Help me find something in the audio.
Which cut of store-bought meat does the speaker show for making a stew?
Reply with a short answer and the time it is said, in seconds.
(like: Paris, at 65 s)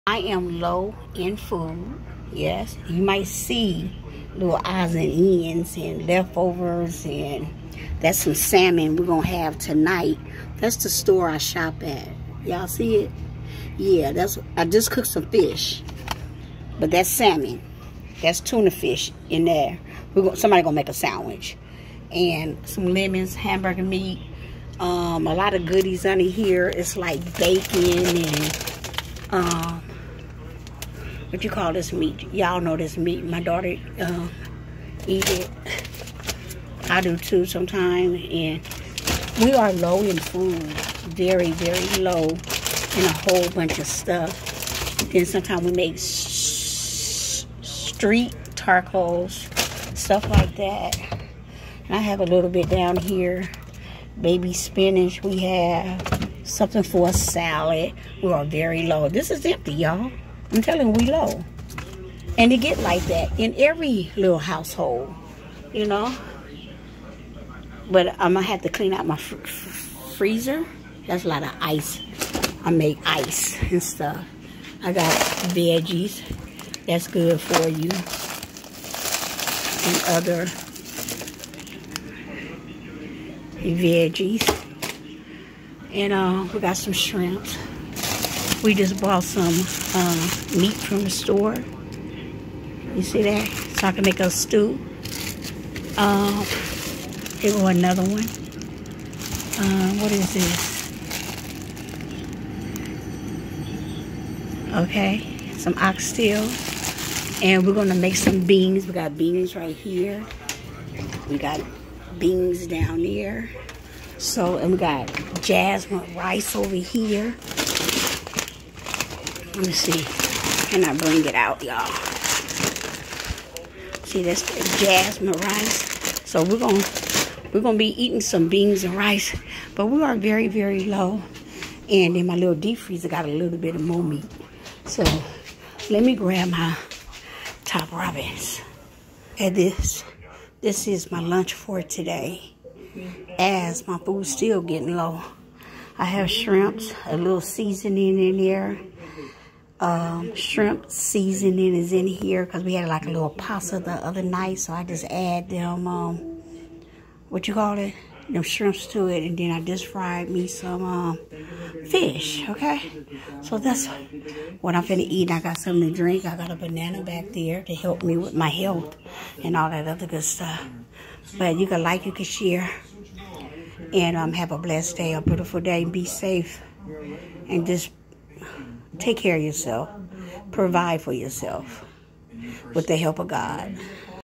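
Oxtail, at 105 s.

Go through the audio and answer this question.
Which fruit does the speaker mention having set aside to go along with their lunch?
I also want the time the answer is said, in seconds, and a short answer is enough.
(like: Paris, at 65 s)
Banana, at 166 s.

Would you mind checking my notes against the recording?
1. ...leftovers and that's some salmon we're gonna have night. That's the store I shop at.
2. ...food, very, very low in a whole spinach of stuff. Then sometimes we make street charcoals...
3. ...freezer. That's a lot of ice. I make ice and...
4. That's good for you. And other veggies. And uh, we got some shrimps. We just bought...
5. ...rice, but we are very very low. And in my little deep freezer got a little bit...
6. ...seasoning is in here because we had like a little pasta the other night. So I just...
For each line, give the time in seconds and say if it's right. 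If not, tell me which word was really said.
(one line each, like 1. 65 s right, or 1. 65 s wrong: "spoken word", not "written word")
1. 6 s wrong: "tonight", not "night"
2. 40 s wrong: "bunch", not "spinach"
3. 70 s right
4. 76 s right
5. 128 s right
6. 150 s right.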